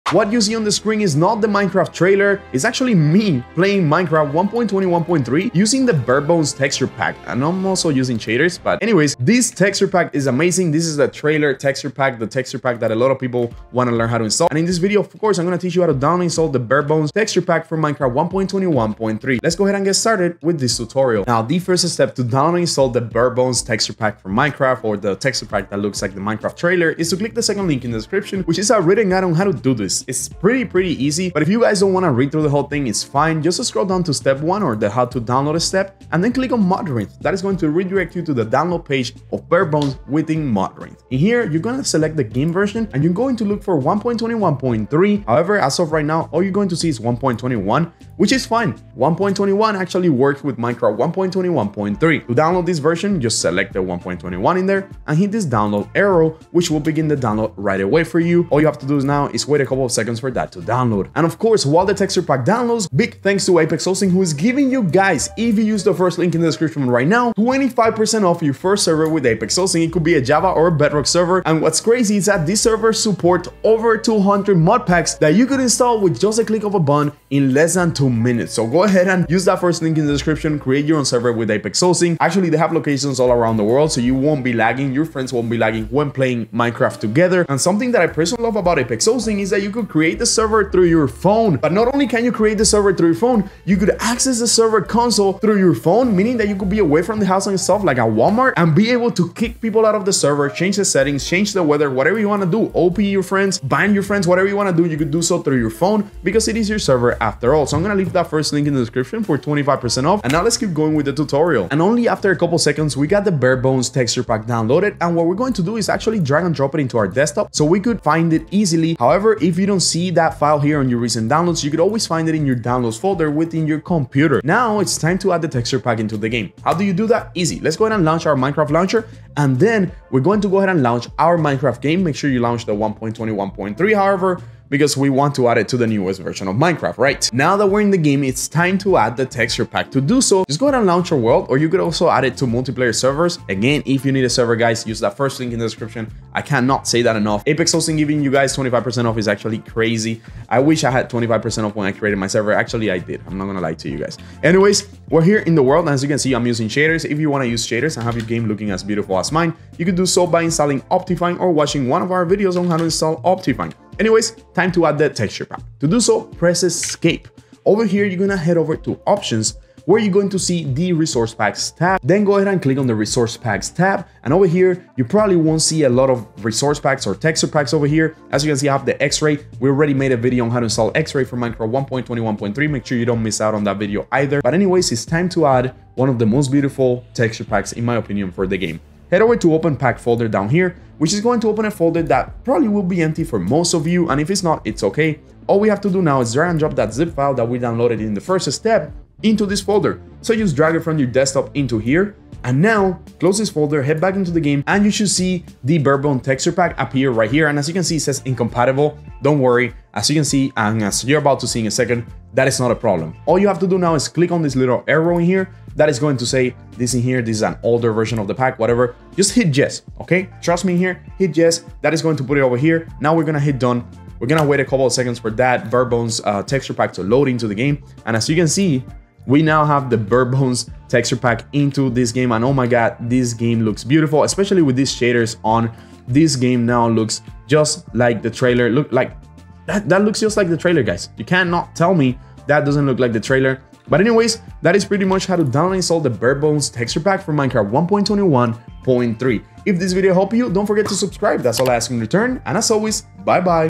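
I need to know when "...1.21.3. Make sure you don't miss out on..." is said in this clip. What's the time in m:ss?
3:01.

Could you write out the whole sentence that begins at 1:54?
And what we're going to do is actually drag and drop it into our desktop so we could find it easily.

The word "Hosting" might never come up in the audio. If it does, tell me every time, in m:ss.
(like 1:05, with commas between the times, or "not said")
1:03, 1:09, 1:21, 1:29, 2:27.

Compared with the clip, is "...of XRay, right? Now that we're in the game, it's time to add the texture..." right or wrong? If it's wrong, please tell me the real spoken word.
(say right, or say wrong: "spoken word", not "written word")
wrong: "Minecraft", not "XRay".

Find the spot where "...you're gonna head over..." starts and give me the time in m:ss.
2:48.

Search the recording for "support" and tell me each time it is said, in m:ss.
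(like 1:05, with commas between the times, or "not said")
1:13.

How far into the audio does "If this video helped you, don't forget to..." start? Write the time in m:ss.
4:09.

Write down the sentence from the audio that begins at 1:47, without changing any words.
So I'm going to leave that first link in the description for 25% off.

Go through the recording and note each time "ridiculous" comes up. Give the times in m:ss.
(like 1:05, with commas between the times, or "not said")
not said.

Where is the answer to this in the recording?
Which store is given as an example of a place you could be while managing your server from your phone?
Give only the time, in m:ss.
1:38.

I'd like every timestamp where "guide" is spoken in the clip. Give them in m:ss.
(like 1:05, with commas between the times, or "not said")
0:29.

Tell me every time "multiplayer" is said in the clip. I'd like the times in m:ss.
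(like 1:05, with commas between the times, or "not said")
2:22.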